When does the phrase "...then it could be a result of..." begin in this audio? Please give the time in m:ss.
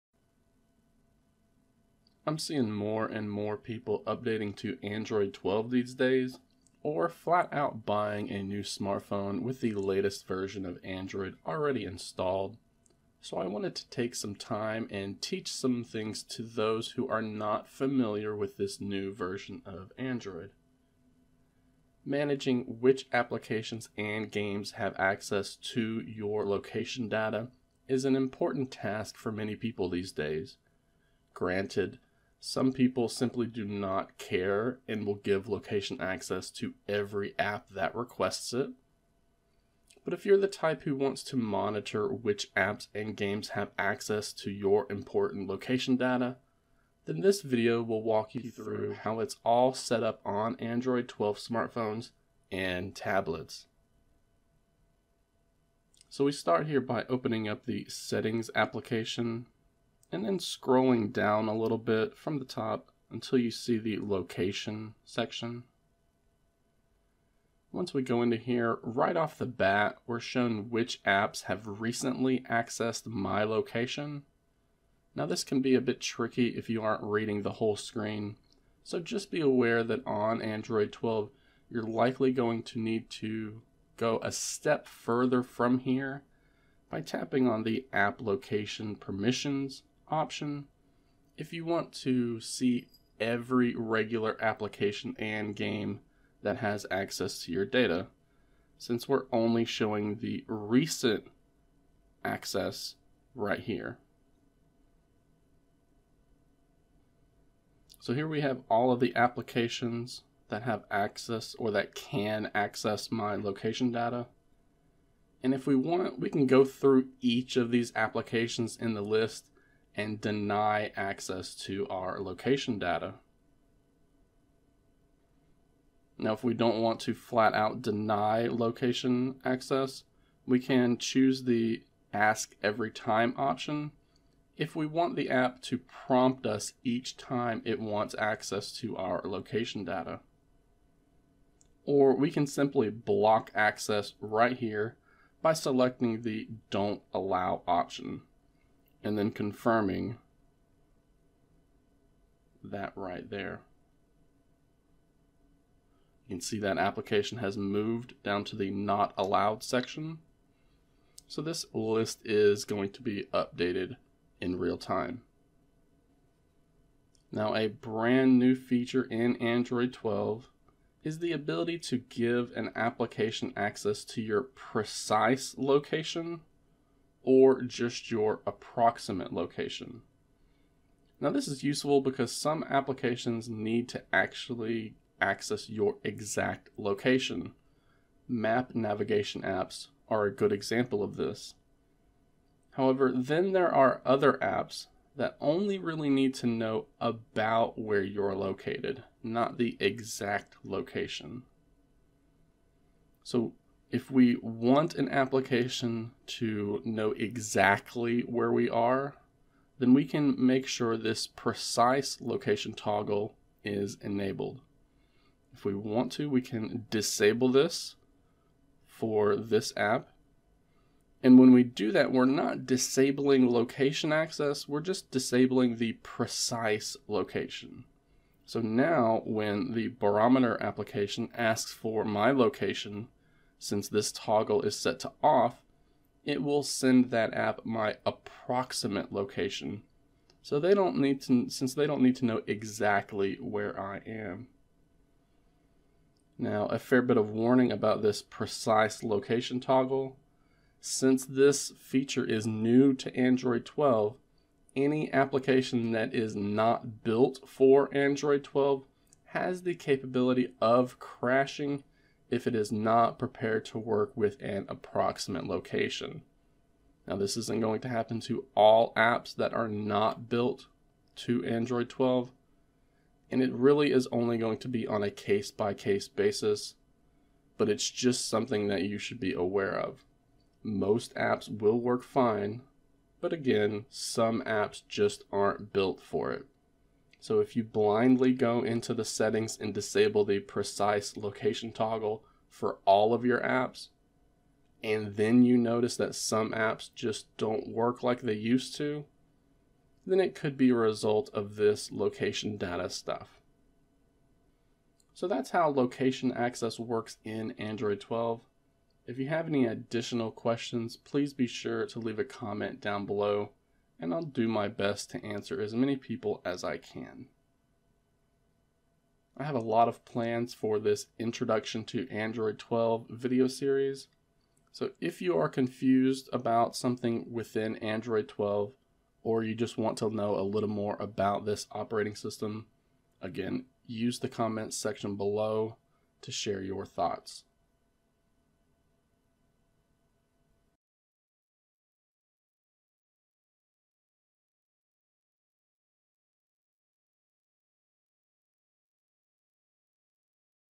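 5:00.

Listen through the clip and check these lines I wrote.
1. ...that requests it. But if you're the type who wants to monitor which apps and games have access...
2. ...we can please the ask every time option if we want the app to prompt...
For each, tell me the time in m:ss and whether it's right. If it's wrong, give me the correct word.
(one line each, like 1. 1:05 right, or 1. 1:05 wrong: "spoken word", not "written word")
1. 0:37 right
2. 2:10 wrong: "choose", not "please".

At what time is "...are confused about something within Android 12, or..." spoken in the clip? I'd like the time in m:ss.
5:25.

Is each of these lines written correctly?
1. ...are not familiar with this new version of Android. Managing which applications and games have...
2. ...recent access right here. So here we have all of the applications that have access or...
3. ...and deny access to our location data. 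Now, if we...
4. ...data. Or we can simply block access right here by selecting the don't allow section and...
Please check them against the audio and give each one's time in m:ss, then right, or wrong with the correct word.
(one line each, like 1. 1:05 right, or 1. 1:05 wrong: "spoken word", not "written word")
1. 0:17 right
2. 1:40 right
3. 1:59 right
4. 2:19 wrong: "option", not "section".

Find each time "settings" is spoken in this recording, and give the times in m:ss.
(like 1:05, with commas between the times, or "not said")
0:57, 4:49.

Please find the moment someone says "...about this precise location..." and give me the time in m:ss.
4:07.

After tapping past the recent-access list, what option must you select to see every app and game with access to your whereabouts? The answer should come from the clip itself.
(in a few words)
app location permissions.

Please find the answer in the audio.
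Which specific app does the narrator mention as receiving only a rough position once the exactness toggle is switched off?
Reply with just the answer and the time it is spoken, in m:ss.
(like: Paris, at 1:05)
barometer, at 3:49.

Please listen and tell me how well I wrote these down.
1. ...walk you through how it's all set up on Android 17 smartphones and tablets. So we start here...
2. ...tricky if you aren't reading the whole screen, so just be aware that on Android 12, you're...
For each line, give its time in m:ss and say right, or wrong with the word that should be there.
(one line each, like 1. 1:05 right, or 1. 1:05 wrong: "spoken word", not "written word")
1. 0:48 wrong: "12", not "17"
2. 1:16 right.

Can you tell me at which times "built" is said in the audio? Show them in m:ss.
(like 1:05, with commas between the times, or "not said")
4:17, 4:30, 4:45.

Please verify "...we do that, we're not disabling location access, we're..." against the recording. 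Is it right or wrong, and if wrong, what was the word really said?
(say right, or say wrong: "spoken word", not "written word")
right.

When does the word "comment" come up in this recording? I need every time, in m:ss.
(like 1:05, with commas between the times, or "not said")
5:12, 5:34.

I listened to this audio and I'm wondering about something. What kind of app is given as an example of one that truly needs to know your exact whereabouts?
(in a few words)
Map navigation apps.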